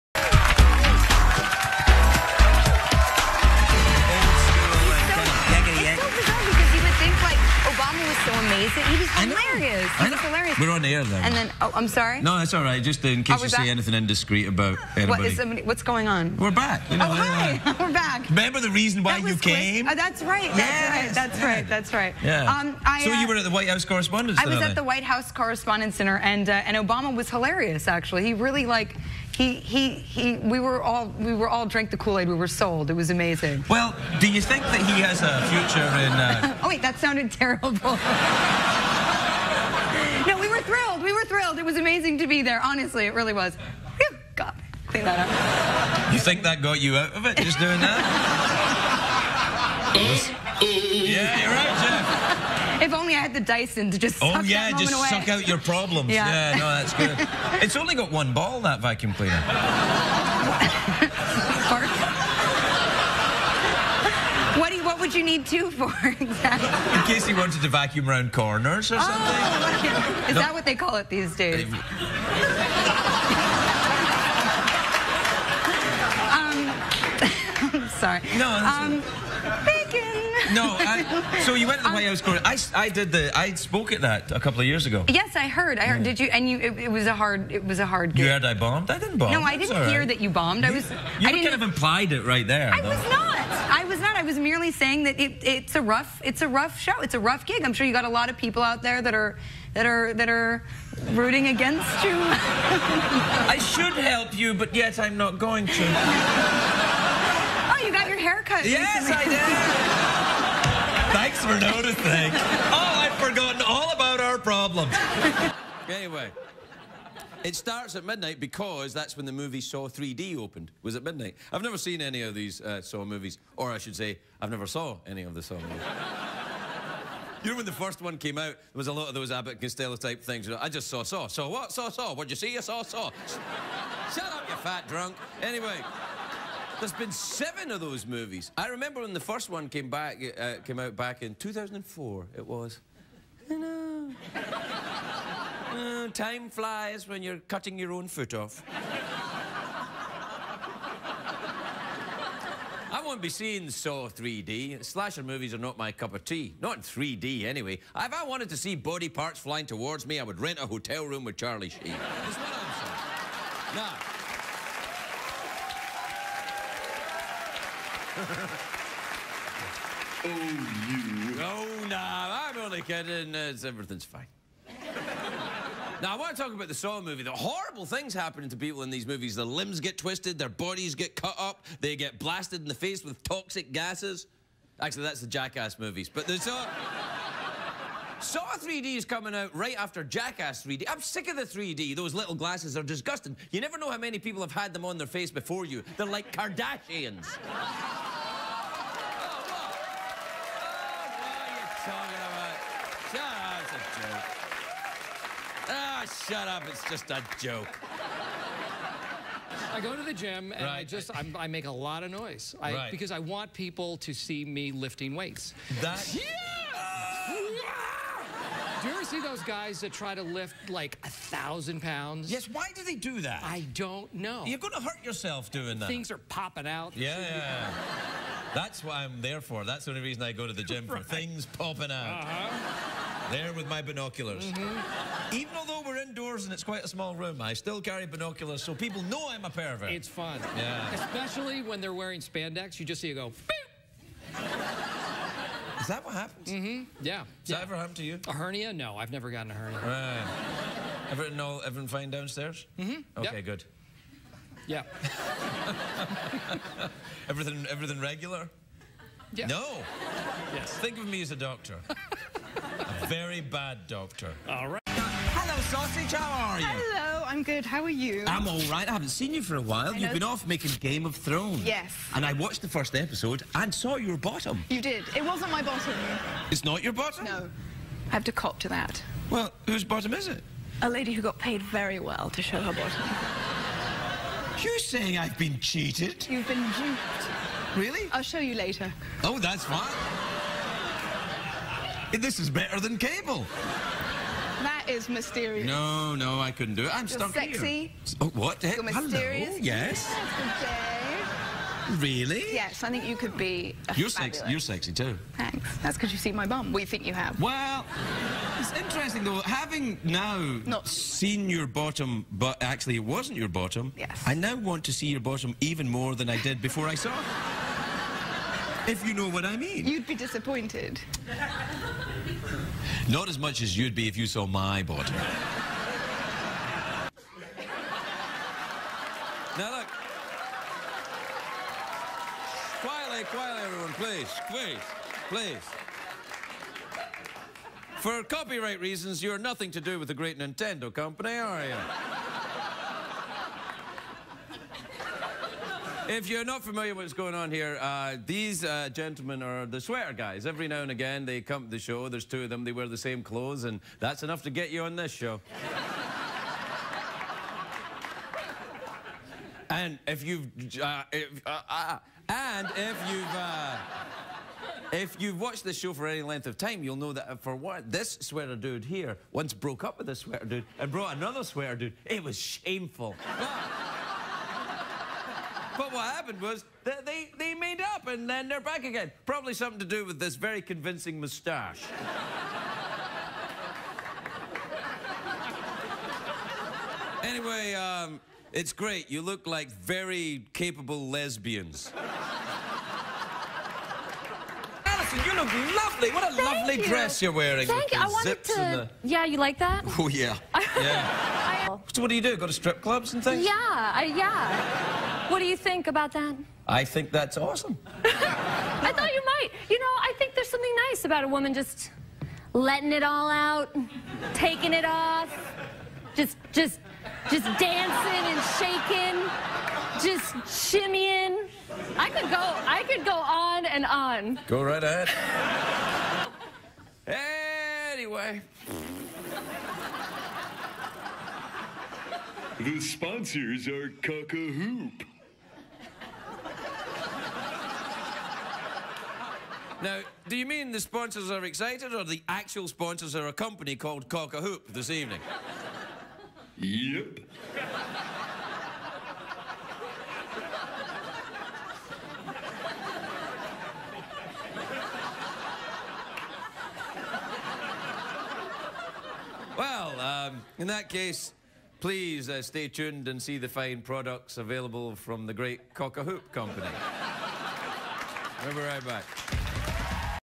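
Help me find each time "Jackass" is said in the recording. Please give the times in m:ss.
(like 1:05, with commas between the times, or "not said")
3:05, 3:10.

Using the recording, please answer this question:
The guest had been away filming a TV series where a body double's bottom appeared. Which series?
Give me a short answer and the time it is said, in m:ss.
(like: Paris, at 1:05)
Game of Thrones, at 4:30.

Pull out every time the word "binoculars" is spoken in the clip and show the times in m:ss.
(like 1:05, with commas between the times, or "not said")
3:53, 3:58.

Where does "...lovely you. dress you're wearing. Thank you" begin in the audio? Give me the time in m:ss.
6:36.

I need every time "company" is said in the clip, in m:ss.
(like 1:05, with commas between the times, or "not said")
5:40, 7:23, 7:46.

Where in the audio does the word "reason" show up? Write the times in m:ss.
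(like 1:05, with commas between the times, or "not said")
0:18, 3:50, 5:38.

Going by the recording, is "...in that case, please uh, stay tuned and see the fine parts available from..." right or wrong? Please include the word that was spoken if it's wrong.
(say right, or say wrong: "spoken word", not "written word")
wrong: "products", not "parts".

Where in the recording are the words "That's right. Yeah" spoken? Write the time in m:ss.
0:21.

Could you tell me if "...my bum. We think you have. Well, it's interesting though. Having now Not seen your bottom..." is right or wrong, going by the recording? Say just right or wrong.
right.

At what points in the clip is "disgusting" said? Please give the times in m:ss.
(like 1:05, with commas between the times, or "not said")
3:12.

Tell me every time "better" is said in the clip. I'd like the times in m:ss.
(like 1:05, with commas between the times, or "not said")
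4:52.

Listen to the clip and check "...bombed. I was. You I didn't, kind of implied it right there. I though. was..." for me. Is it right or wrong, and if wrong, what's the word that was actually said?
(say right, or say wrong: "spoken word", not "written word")
right.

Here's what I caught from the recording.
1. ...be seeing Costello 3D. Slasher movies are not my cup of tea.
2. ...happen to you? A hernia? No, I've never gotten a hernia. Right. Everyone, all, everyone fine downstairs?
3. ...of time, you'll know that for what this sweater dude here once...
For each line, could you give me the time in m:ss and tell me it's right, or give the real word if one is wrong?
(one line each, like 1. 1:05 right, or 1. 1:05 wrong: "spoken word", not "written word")
1. 2:33 wrong: "Saw", not "Costello"
2. 4:07 right
3. 6:06 right.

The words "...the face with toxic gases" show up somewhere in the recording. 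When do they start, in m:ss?
3:02.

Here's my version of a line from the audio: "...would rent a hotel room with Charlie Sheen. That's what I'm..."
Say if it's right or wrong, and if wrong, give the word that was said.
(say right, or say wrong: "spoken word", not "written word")
right.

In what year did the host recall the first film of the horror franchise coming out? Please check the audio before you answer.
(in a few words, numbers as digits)
2004.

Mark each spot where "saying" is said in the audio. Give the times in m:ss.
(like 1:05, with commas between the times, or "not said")
1:34, 2:43, 4:44.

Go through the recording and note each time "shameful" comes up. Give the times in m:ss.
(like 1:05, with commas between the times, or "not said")
6:12.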